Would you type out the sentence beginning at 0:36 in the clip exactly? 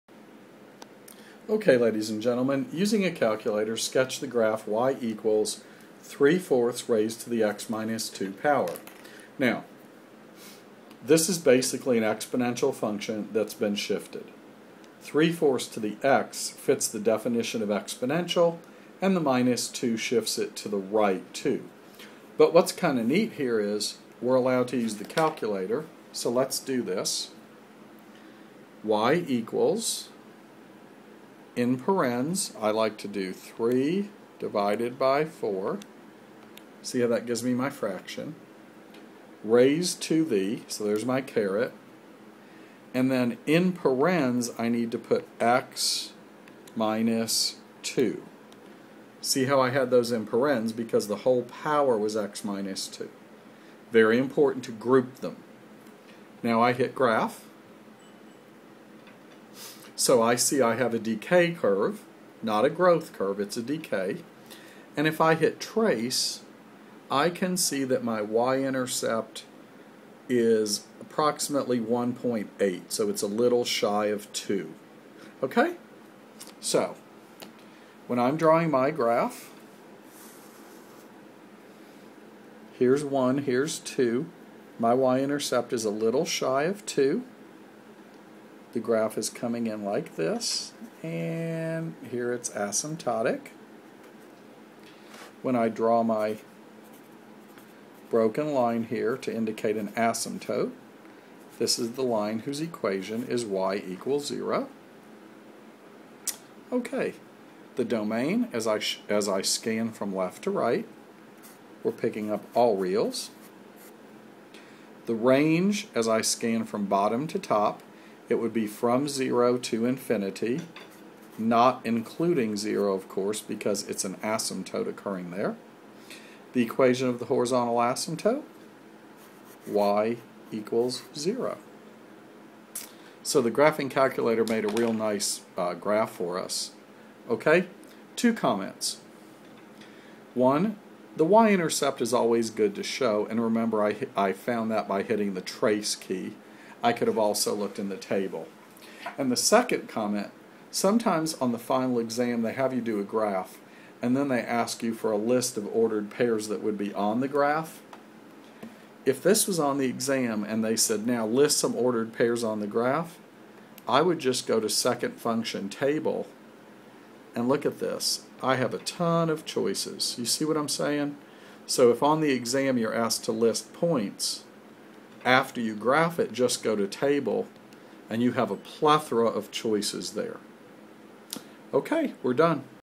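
See how that gives me my fraction.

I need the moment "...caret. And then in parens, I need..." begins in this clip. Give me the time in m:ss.
0:41.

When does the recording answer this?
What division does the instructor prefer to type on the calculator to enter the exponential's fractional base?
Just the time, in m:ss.
0:33.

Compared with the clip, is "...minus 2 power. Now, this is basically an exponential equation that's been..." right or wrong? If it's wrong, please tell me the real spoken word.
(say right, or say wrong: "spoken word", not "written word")
wrong: "function", not "equation".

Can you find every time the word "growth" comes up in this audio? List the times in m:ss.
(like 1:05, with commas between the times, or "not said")
1:02.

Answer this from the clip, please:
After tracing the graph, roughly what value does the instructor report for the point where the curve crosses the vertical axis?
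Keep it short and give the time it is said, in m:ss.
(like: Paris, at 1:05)
1.8, at 1:11.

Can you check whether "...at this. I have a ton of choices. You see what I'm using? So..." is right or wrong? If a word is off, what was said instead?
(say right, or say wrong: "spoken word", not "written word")
wrong: "saying", not "using".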